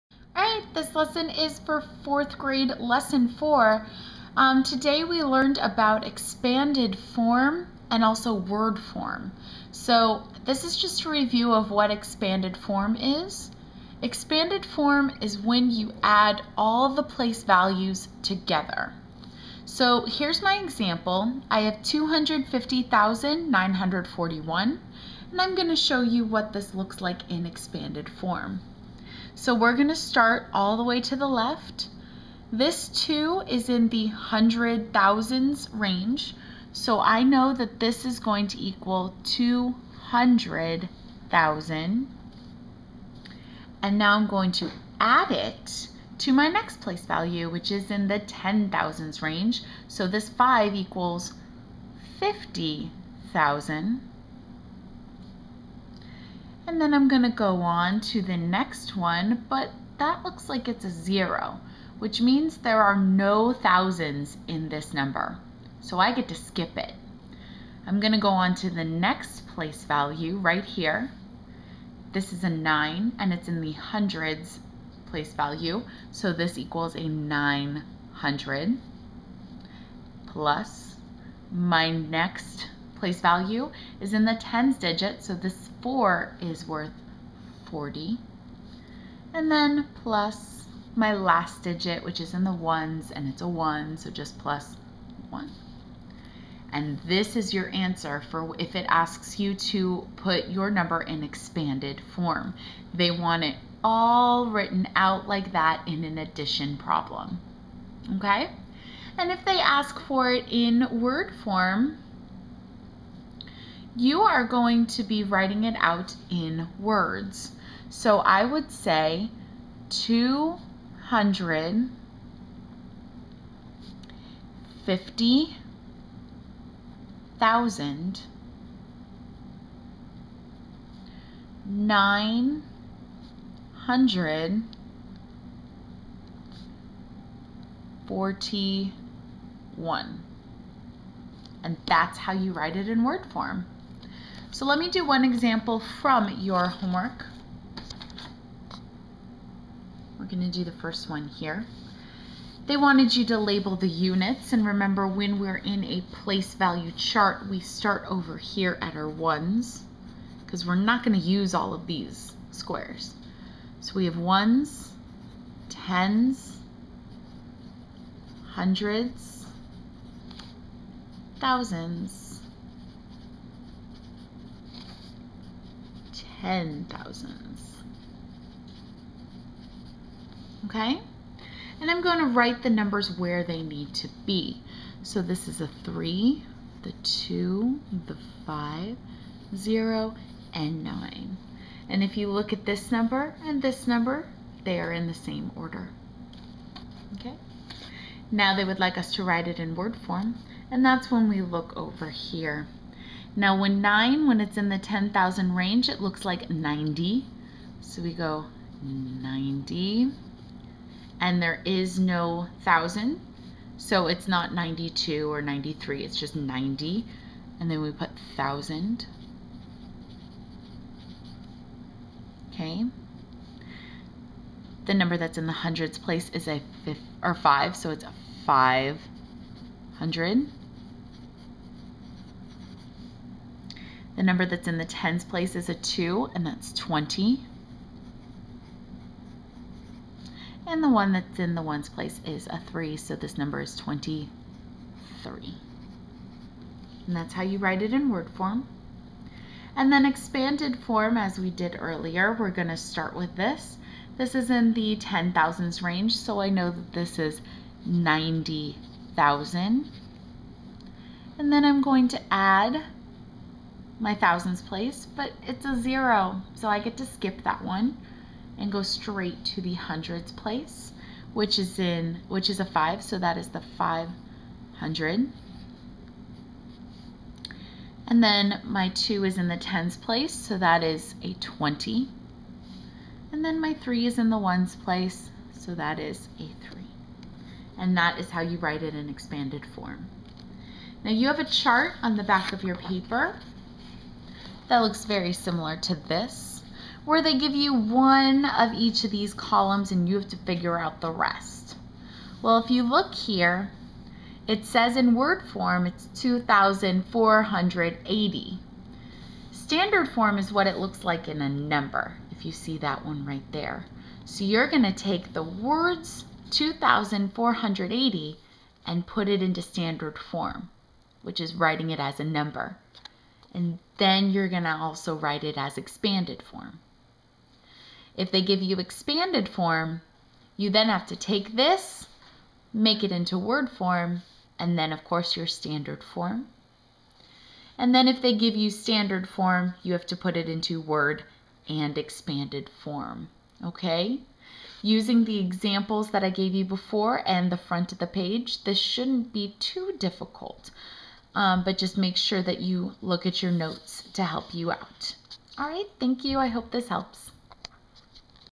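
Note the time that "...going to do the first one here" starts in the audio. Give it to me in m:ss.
2:30.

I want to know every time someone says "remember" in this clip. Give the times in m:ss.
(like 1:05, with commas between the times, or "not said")
2:34.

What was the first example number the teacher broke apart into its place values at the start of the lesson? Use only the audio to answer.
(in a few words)
250,941.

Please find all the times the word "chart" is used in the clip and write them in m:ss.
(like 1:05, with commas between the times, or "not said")
2:36, 4:51.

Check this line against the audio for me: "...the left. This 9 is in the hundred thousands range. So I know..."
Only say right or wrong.
wrong.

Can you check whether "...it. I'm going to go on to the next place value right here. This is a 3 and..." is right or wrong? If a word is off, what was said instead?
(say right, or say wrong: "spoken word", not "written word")
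wrong: "9", not "3".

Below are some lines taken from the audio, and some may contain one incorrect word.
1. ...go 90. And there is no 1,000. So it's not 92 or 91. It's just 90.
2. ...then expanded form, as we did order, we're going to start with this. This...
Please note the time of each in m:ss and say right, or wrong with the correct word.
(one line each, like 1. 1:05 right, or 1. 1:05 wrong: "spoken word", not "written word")
1. 3:28 wrong: "93", not "91"
2. 4:09 wrong: "earlier", not "order".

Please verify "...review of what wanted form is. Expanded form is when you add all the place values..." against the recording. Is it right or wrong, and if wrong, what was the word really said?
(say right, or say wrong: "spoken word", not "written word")
wrong: "expanded", not "wanted".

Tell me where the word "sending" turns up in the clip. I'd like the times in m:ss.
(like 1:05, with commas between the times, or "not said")
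not said.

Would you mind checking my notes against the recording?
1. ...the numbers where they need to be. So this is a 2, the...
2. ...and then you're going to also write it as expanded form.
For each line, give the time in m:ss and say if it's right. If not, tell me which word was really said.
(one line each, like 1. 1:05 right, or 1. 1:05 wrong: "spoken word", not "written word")
1. 3:02 wrong: "3", not "2"
2. 5:23 right.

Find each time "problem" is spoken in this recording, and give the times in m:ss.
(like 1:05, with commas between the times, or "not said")
1:46.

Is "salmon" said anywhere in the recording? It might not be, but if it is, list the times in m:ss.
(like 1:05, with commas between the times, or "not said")
not said.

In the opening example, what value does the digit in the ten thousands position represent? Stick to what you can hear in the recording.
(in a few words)
50,000.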